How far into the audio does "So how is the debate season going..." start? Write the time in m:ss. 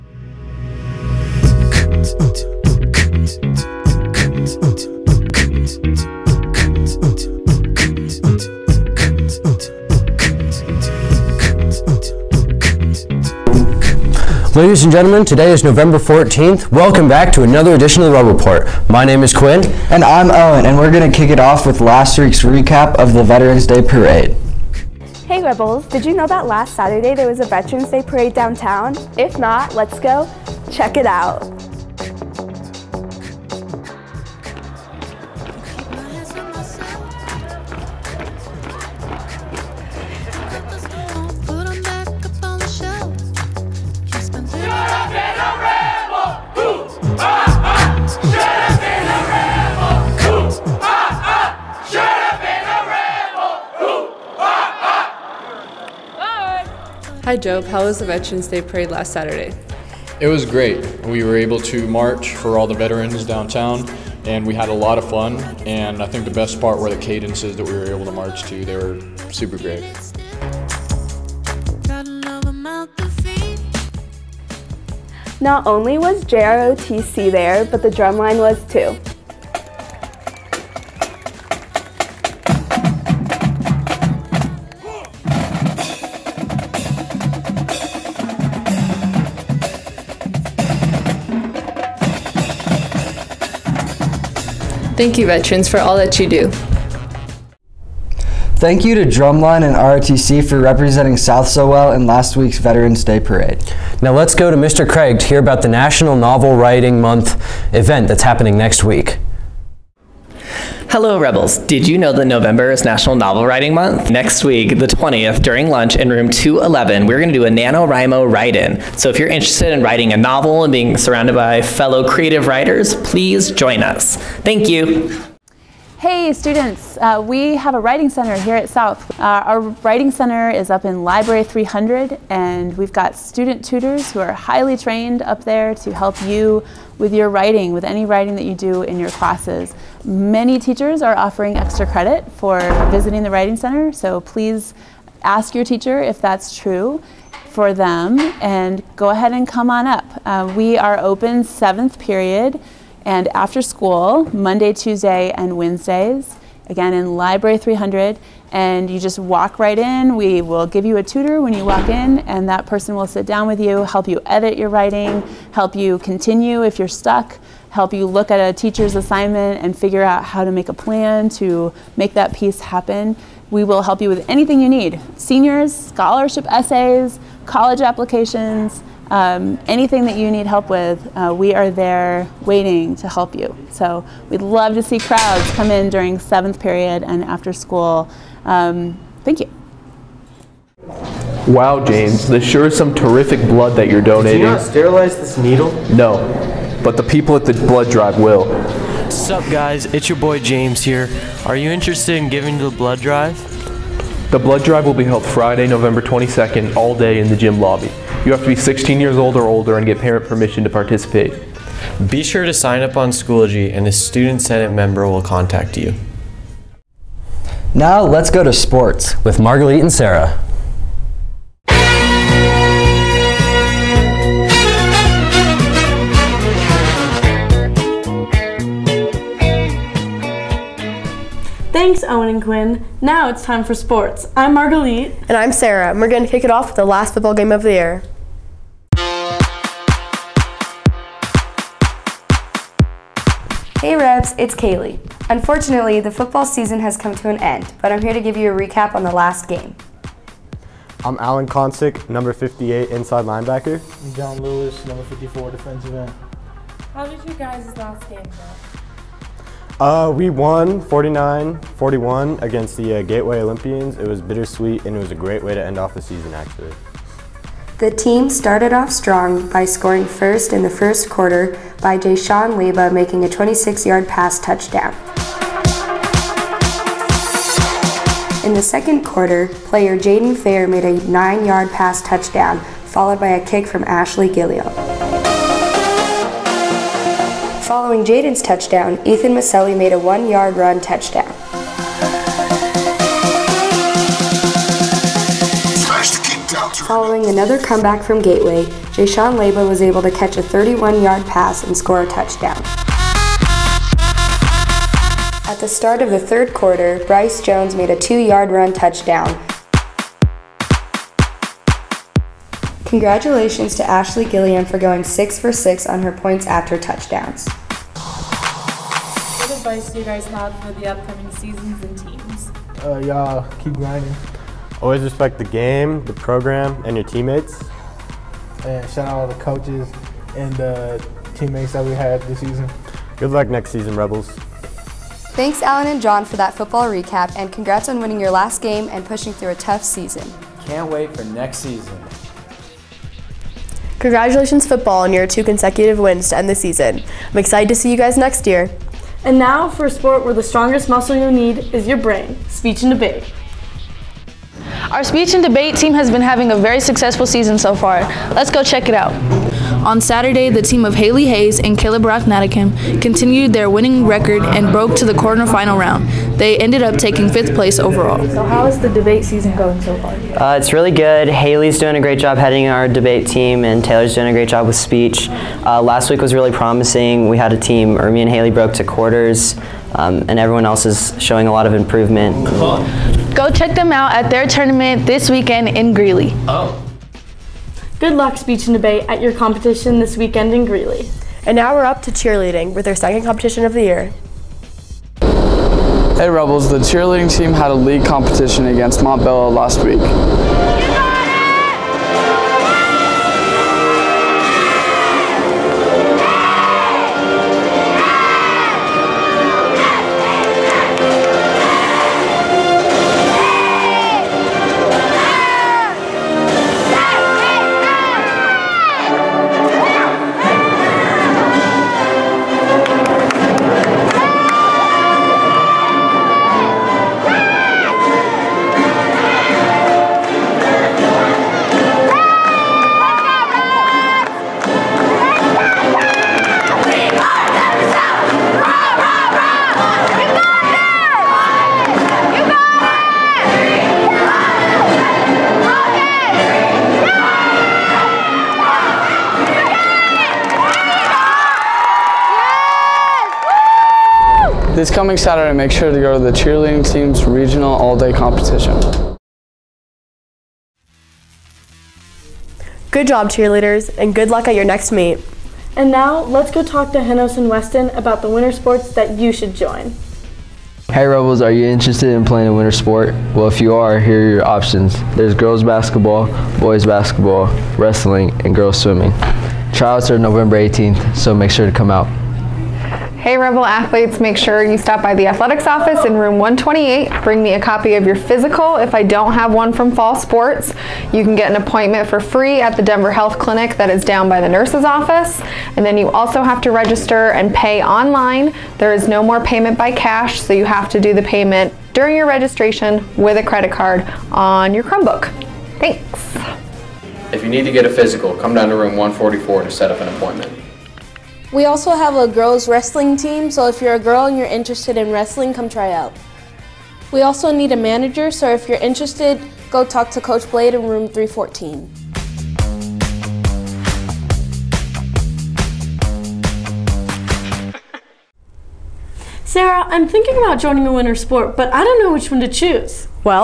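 6:08.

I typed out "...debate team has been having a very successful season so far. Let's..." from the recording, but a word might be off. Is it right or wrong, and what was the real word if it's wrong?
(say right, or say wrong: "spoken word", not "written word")
right.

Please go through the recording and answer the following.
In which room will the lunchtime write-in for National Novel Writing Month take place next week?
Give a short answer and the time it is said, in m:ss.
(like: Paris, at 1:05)
Room 211, at 1:56.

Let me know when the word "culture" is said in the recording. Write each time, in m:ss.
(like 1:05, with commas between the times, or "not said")
not said.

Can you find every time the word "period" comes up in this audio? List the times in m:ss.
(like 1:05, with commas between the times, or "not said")
2:31, 3:06.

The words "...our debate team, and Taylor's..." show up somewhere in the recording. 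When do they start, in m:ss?
6:12.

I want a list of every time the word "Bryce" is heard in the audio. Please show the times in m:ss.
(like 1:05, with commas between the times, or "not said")
5:07.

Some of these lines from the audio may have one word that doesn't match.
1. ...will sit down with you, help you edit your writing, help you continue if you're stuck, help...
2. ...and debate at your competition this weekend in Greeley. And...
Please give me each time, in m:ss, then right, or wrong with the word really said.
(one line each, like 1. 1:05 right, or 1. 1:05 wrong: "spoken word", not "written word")
1. 2:42 right
2. 6:28 right.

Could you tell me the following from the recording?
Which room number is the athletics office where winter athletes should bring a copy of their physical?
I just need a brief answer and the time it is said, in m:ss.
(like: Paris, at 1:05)
Room 128, at 8:06.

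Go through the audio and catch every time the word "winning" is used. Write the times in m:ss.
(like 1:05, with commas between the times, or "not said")
5:37, 6:03.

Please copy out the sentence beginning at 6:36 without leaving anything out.
Hey Rebels, the cheerleading team had a league competition against Montbello last week.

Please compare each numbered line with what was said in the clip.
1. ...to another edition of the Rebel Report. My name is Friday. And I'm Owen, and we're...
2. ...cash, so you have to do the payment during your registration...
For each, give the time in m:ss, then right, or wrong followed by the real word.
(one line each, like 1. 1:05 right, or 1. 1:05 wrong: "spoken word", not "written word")
1. 0:17 wrong: "Quinn", not "Friday"
2. 8:19 right.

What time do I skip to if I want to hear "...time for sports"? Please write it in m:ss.
3:53.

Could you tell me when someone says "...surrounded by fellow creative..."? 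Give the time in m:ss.
2:00.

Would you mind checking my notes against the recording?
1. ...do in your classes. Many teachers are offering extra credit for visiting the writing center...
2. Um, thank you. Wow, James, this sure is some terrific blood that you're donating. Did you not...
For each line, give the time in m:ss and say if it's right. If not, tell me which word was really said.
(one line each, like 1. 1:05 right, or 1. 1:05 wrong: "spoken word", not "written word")
1. 2:18 right
2. 3:08 right.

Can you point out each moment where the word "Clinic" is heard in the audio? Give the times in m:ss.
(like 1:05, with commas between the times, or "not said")
8:13.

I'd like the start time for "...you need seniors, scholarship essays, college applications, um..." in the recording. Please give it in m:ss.
2:54.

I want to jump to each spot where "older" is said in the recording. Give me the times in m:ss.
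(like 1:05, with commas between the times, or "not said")
3:29.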